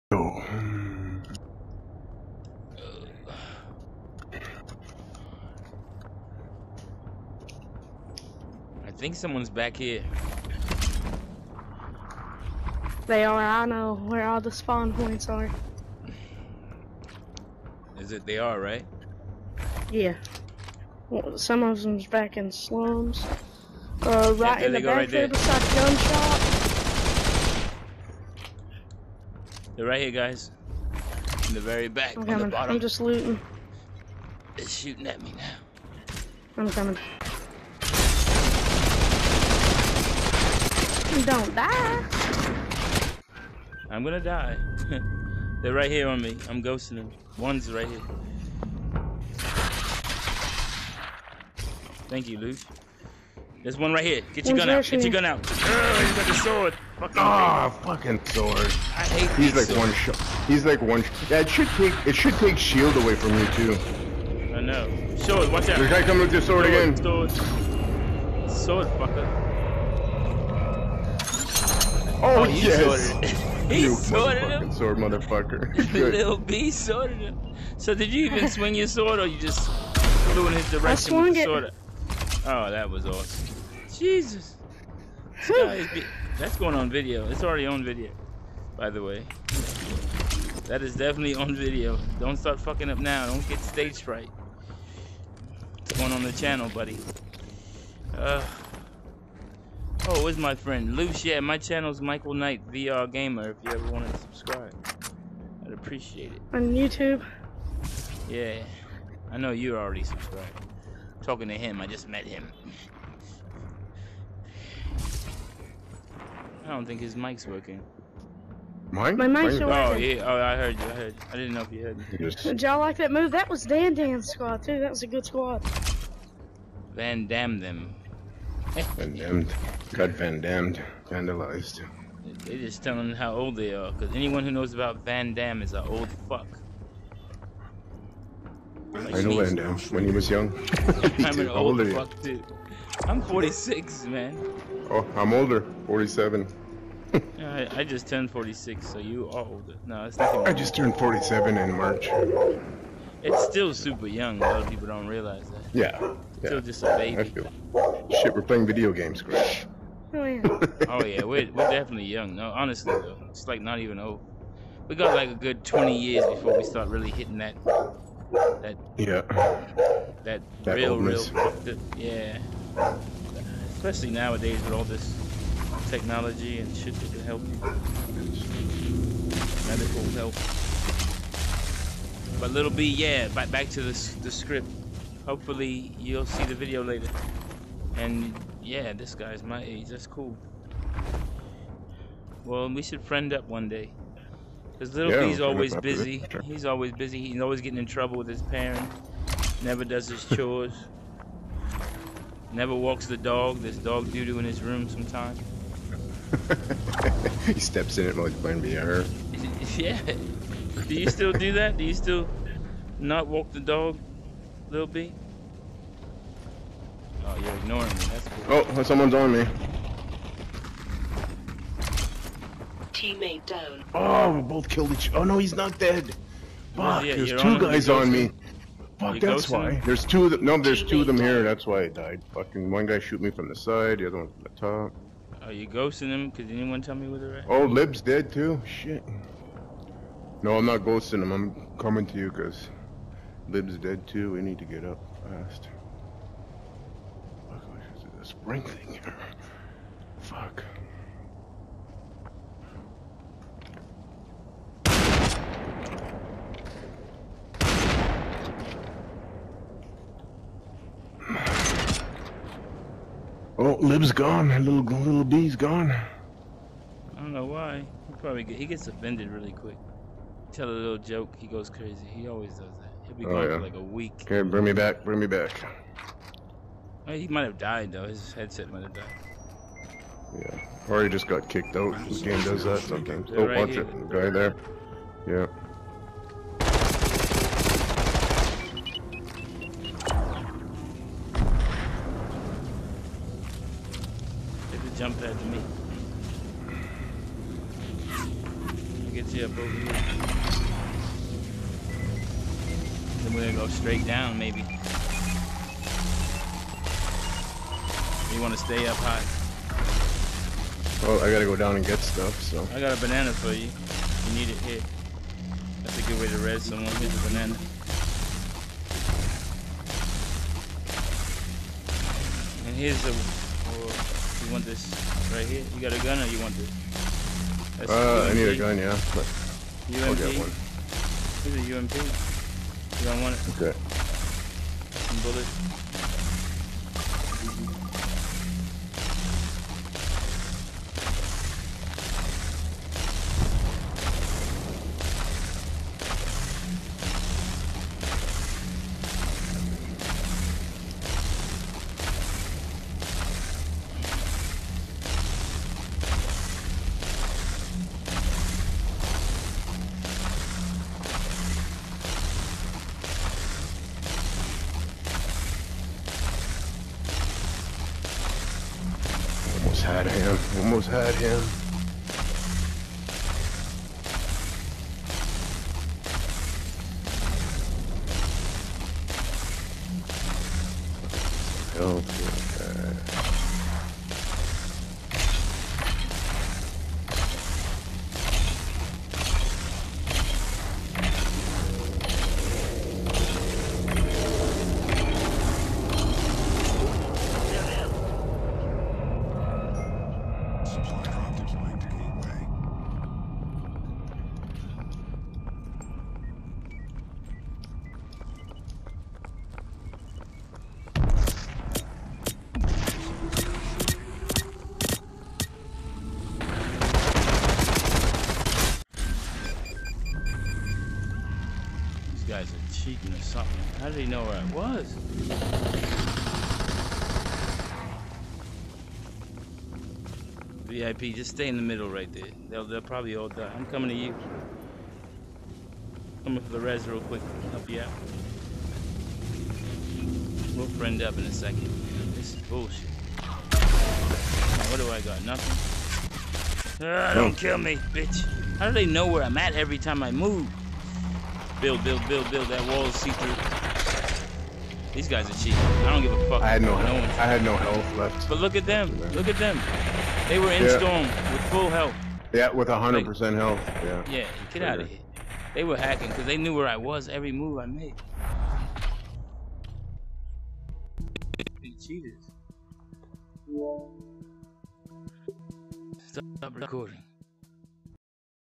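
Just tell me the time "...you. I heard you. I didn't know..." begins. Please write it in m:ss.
2:00.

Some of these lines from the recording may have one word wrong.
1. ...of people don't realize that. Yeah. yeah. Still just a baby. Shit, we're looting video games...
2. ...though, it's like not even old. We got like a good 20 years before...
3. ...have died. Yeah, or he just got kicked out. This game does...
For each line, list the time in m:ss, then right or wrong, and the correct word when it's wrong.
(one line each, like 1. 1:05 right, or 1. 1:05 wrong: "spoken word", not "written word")
1. 2:34 wrong: "playing", not "looting"
2. 2:42 right
3. 4:38 right.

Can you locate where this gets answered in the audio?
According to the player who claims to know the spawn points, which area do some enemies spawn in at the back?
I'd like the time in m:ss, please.
0:22.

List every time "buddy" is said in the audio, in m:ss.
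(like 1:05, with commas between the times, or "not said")
1:36.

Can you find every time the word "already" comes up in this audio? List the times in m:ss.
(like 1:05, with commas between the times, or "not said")
1:27, 1:49.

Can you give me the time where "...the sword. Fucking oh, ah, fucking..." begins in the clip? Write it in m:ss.
0:56.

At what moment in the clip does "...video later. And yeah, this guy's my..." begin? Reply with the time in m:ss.
3:06.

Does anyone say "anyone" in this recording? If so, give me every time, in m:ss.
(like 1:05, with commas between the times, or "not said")
2:14, 3:56.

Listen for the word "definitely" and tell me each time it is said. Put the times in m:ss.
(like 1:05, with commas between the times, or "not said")
1:30, 2:41.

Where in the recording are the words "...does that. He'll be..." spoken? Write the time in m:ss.
4:32.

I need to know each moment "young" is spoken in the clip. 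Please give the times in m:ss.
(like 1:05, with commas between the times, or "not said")
2:20, 2:34, 2:42.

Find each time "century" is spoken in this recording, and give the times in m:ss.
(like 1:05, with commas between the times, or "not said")
not said.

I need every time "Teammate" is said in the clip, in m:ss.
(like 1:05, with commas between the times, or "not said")
3:42, 3:50.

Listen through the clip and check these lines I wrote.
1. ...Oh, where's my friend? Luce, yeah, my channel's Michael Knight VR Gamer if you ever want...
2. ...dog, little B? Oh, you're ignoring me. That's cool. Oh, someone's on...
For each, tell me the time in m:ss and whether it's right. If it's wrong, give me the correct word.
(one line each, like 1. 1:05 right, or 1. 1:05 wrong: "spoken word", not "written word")
1. 1:40 right
2. 3:33 right.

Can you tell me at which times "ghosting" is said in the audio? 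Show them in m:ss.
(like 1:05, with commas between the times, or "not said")
0:46, 3:55, 4:00.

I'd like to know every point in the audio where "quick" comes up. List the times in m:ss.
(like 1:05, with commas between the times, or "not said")
4:29, 7:17.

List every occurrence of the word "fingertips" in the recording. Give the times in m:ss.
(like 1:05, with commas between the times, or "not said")
not said.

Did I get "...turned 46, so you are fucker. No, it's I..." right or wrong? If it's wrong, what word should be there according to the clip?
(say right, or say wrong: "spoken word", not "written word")
wrong: "older", not "fucker".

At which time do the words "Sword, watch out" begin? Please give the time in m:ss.
1:05.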